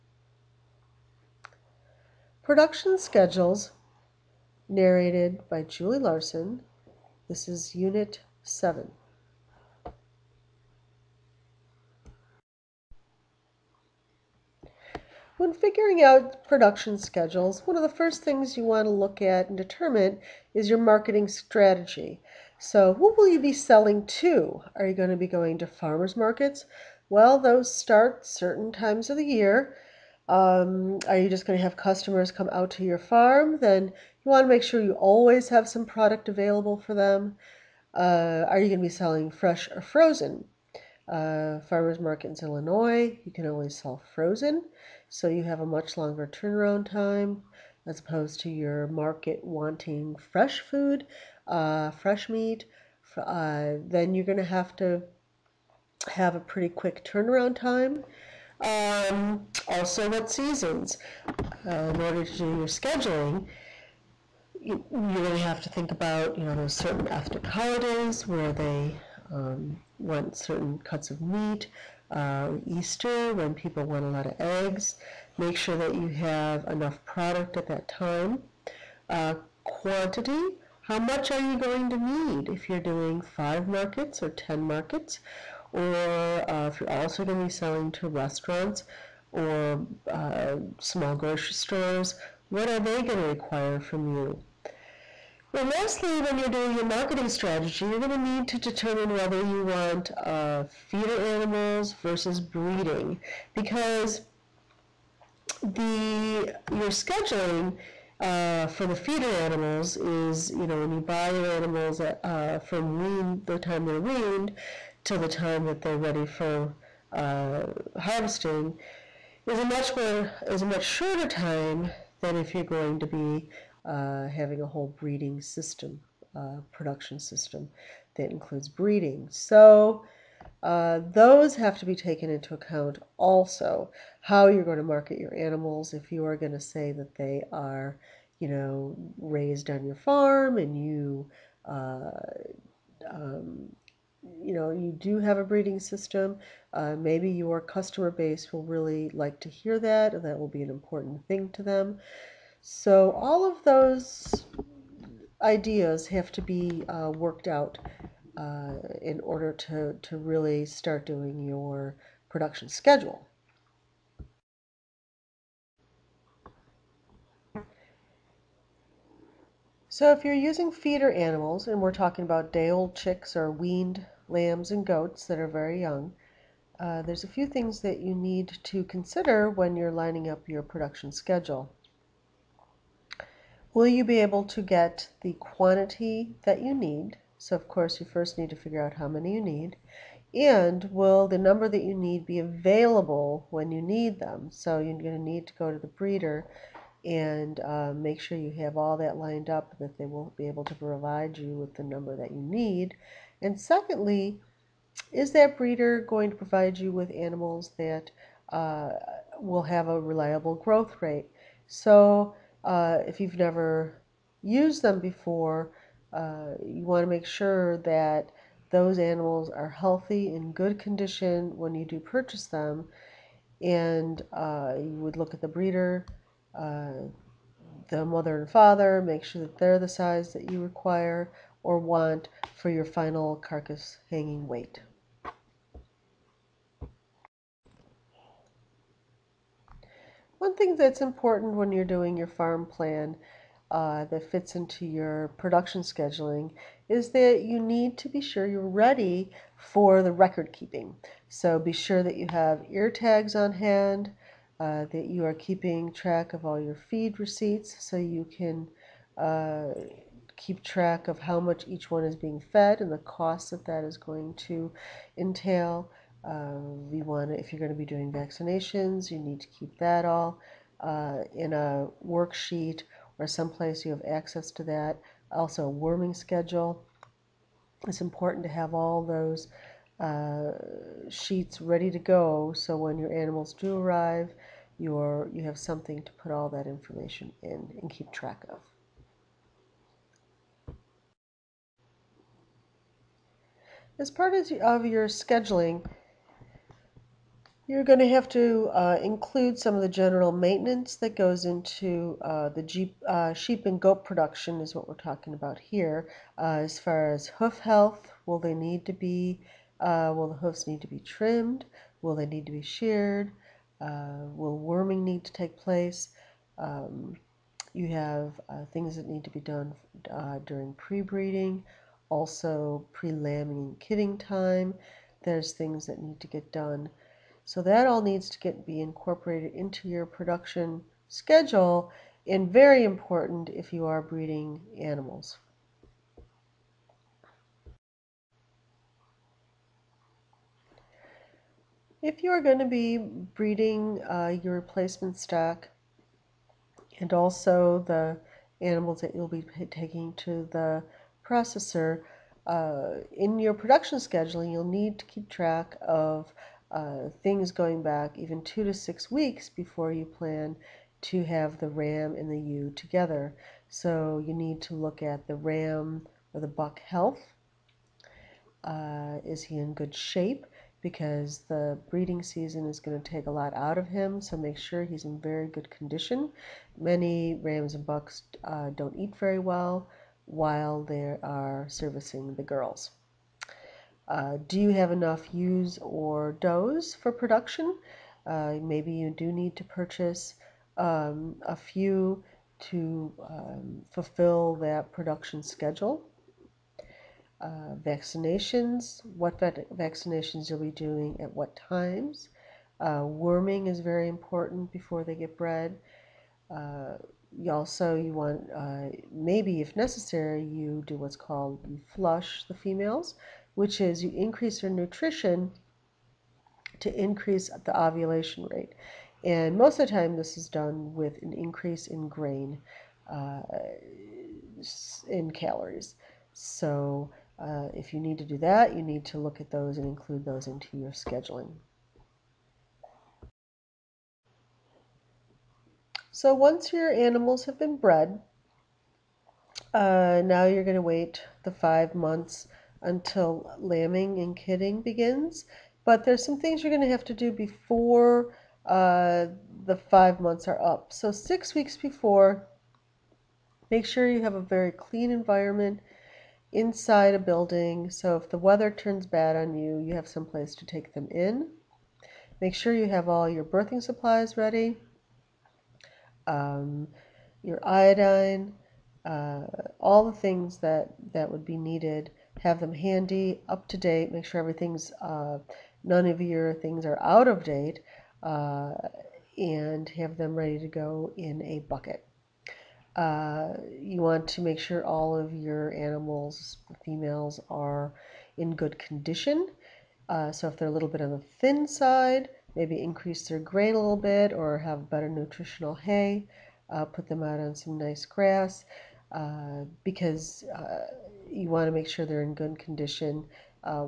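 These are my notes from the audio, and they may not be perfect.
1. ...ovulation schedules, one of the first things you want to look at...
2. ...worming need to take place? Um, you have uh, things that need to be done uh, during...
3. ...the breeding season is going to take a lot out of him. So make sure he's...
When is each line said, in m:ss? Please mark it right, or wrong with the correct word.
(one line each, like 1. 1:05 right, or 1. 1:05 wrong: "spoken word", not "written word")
1. 0:16 wrong: "production", not "ovulation"
2. 5:14 right
3. 6:11 right.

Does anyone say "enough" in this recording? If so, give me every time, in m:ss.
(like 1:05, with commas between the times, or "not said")
1:16, 6:24.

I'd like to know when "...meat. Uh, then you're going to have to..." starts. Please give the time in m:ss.
0:52.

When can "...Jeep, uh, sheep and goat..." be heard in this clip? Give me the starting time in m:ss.
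5:02.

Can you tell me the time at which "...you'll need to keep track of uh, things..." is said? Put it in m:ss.
5:54.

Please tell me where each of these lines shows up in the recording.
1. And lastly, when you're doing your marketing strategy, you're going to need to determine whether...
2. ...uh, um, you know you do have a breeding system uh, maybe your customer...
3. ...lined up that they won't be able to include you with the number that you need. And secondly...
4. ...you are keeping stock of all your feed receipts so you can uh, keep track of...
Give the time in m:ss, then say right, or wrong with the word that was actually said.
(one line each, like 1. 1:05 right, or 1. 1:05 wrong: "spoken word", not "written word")
1. 1:35 right
2. 2:21 right
3. 3:19 wrong: "provide", not "include"
4. 4:15 wrong: "track", not "stock".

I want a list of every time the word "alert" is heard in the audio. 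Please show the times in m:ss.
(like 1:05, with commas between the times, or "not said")
not said.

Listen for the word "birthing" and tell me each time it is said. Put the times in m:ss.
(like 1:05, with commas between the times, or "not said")
7:43.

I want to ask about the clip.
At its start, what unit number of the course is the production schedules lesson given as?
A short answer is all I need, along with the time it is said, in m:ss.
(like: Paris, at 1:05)
7, at 0:07.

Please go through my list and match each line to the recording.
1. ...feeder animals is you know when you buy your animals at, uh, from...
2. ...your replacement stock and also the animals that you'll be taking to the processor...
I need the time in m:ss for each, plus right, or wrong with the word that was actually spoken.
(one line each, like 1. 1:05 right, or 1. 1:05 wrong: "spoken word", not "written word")
1. 1:48 right
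2. 5:44 right.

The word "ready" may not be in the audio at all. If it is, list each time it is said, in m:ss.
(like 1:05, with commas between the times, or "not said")
1:55, 4:08, 4:41, 7:44, 8:00.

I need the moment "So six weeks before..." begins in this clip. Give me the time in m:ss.
7:30.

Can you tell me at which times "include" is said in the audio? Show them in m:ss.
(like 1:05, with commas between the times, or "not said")
2:08, 4:59, 7:09.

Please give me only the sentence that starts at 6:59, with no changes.
And most of the time, this is done with an increase in grain uh, in calories.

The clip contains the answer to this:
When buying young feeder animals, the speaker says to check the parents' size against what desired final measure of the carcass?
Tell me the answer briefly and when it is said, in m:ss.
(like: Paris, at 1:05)
hanging weight, at 3:54.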